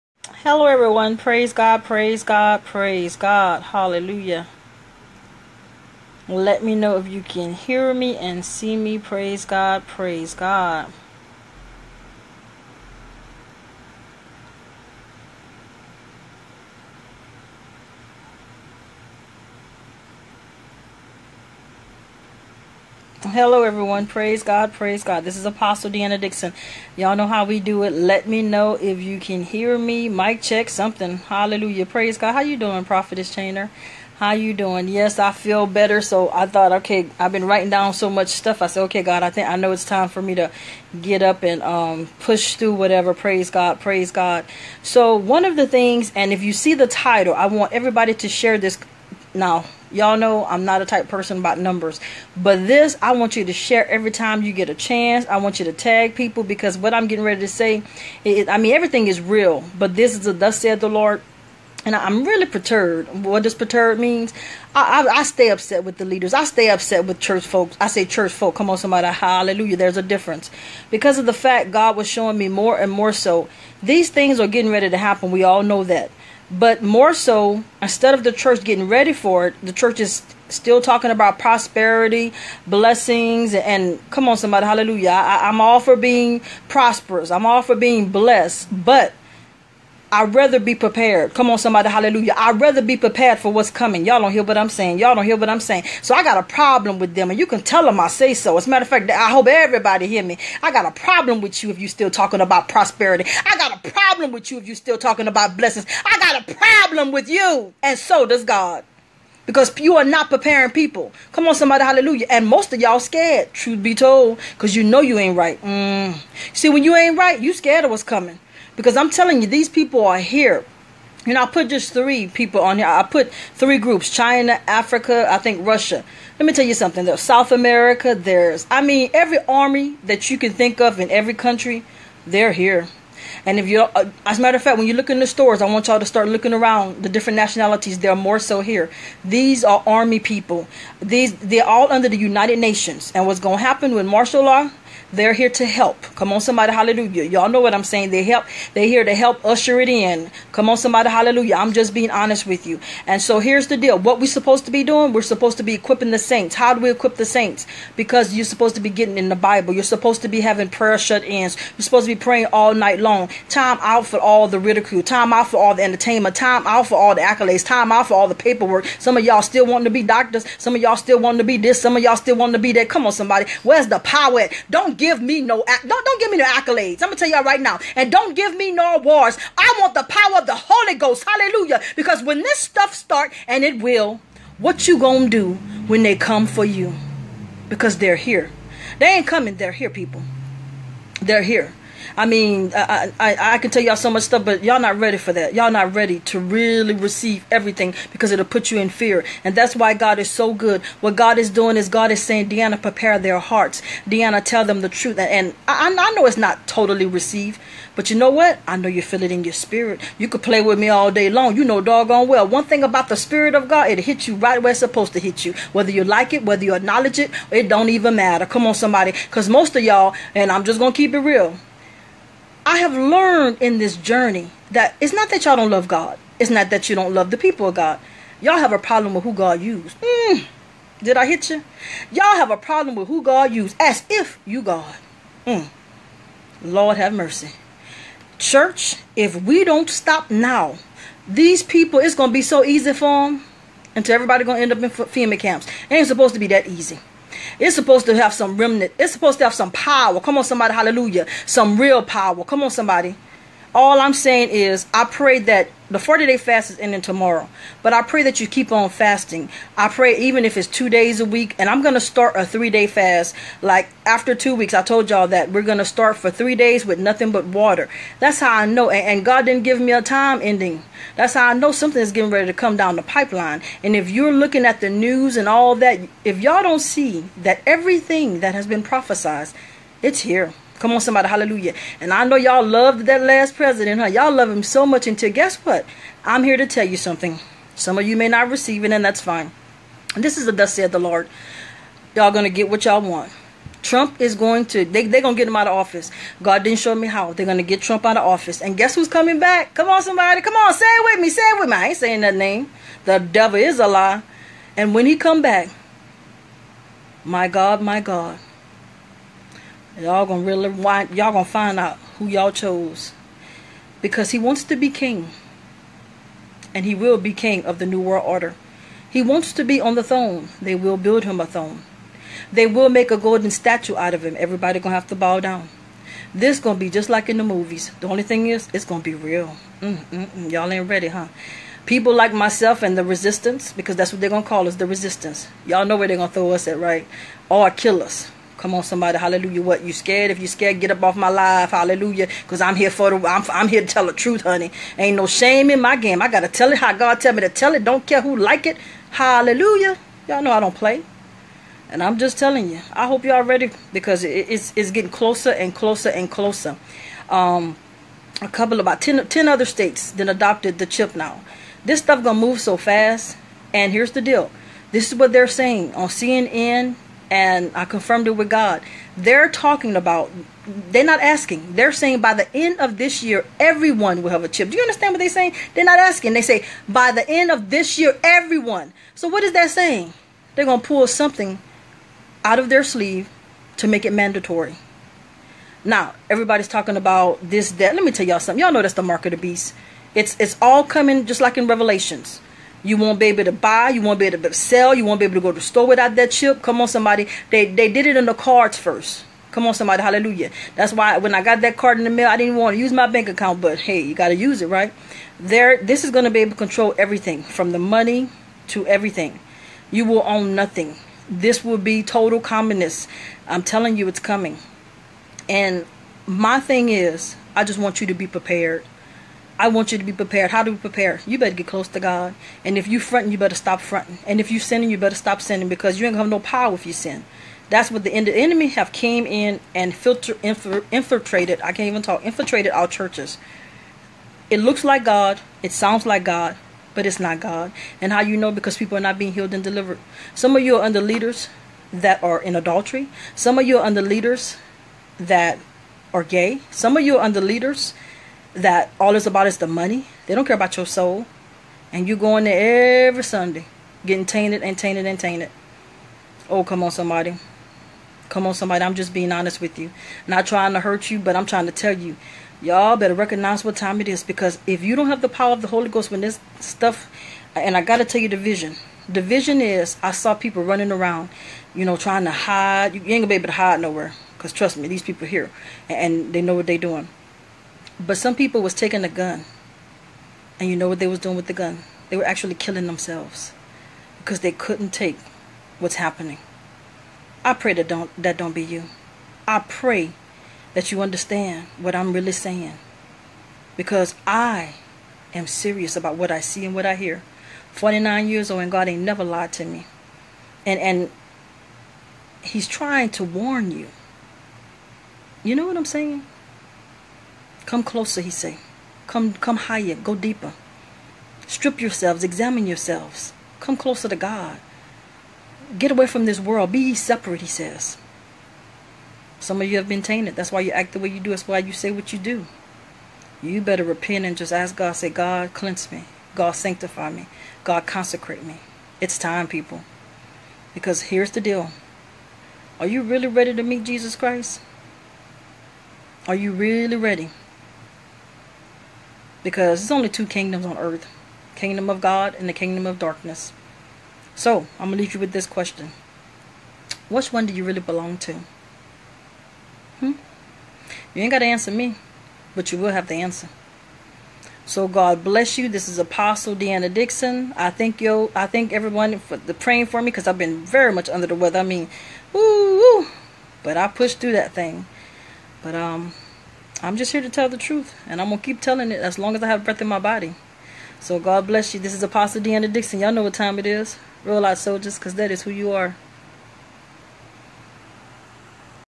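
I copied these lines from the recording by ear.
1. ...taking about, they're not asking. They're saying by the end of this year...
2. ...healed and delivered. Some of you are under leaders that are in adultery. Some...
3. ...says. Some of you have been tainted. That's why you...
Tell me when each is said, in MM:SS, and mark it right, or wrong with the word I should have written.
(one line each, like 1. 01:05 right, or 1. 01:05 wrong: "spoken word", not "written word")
1. 06:09 wrong: "talking", not "taking"
2. 07:19 right
3. 08:37 right.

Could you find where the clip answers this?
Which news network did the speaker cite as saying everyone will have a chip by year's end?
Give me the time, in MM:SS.
06:06.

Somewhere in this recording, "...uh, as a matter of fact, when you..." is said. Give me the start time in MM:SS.
02:13.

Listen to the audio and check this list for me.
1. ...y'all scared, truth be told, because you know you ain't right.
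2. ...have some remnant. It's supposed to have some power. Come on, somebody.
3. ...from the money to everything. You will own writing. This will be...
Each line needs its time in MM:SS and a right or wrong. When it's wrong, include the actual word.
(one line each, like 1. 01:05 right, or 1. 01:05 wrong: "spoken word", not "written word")
1. 01:52 right
2. 04:08 right
3. 06:47 wrong: "nothing", not "writing".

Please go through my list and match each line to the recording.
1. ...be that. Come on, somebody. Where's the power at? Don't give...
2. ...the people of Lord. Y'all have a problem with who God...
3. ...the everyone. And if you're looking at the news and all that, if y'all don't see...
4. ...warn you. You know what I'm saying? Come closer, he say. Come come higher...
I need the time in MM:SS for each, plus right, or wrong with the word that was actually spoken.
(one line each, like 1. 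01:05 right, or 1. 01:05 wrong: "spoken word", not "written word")
1. 02:52 right
2. 03:47 wrong: "God", not "Lord"
3. 04:32 wrong: "pipeline", not "everyone"
4. 08:23 right.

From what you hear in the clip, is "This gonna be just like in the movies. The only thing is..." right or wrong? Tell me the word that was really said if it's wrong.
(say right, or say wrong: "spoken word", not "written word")
right.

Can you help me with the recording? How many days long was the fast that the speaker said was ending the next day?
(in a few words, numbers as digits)
40.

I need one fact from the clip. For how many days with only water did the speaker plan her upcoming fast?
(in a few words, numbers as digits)
3.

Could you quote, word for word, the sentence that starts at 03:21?
What God is doing is God is saying, Deanna, prepare their hearts.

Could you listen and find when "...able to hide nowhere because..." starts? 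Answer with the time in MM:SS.
07:53.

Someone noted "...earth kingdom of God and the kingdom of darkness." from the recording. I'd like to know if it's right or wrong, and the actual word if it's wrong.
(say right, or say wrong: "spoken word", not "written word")
right.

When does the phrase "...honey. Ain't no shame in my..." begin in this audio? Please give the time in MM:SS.
05:44.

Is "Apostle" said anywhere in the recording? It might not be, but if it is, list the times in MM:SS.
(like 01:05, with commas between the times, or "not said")
00:25, 09:15, 09:32.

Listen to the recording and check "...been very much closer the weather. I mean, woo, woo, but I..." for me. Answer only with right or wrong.
wrong.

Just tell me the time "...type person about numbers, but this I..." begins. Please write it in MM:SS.
00:50.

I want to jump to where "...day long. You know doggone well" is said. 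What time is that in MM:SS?
03:31.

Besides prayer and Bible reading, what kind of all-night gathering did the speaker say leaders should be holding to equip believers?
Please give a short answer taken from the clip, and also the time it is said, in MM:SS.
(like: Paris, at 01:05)
Prayer shut-ins, at 02:40.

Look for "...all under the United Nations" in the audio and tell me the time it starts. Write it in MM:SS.
02:21.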